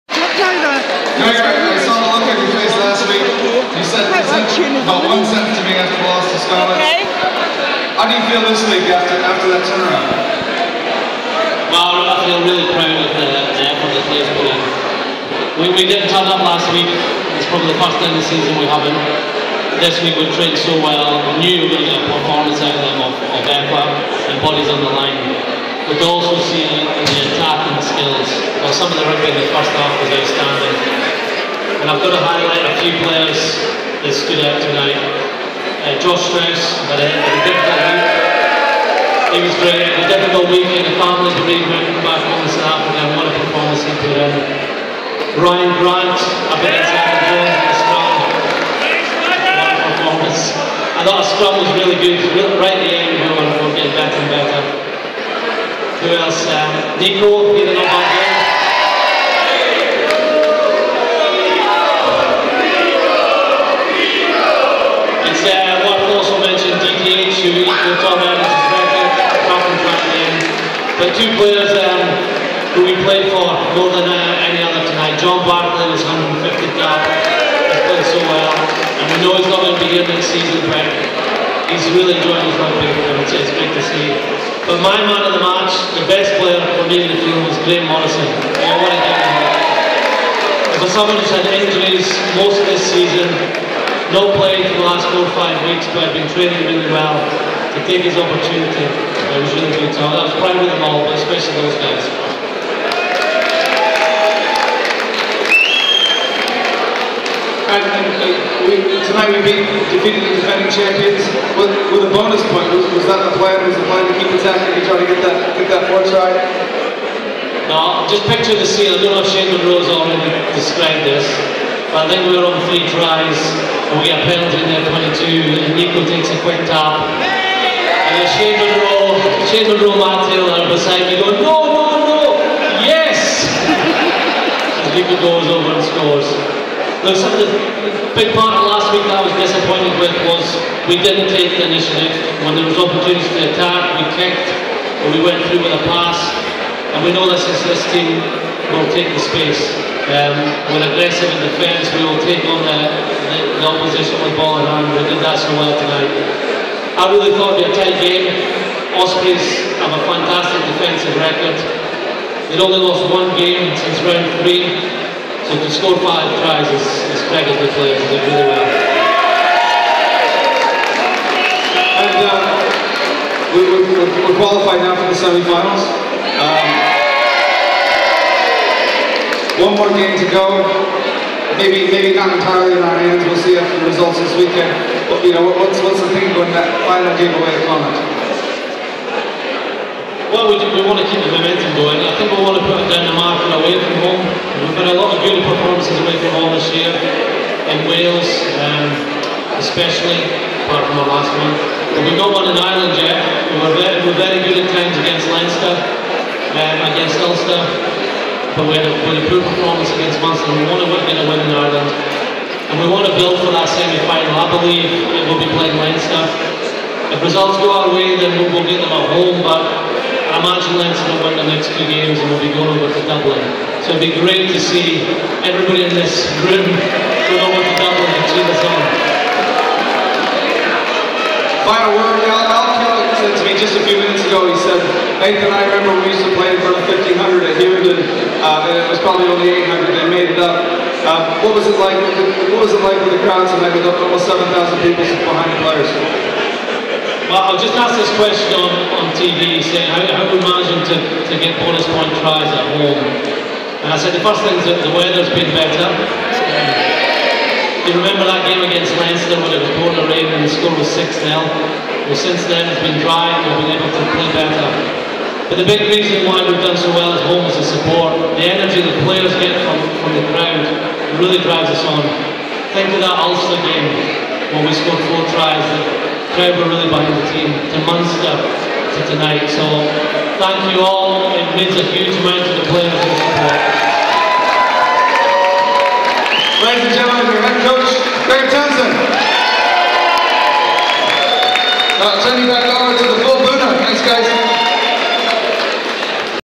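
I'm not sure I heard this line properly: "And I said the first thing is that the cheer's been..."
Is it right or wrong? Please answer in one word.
wrong.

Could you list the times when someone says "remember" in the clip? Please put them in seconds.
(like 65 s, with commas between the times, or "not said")
235 s, 257 s.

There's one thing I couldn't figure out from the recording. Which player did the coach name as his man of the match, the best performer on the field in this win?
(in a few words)
Graham Morrison.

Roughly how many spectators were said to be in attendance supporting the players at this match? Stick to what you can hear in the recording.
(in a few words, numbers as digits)
7,000.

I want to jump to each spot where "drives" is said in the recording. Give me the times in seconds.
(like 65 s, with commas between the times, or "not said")
271 s.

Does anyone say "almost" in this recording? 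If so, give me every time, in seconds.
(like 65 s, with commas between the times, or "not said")
243 s.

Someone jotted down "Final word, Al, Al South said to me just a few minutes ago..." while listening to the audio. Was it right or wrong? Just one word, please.
wrong.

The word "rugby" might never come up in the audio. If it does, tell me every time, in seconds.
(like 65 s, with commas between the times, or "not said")
29 s, 82 s.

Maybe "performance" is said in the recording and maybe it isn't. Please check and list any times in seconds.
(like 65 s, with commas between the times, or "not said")
22 s, 43 s, 49 s, 195 s, 209 s.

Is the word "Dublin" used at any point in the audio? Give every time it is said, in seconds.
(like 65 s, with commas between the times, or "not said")
223 s, 227 s.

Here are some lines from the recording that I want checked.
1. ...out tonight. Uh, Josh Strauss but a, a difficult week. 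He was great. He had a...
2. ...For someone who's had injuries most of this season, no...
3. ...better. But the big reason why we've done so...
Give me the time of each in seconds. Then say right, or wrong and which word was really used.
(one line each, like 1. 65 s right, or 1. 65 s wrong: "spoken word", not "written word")
1. 34 s right
2. 90 s right
3. 264 s right.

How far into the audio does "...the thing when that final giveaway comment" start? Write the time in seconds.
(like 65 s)
185 s.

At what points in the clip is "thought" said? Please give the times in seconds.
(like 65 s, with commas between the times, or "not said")
51 s, 157 s.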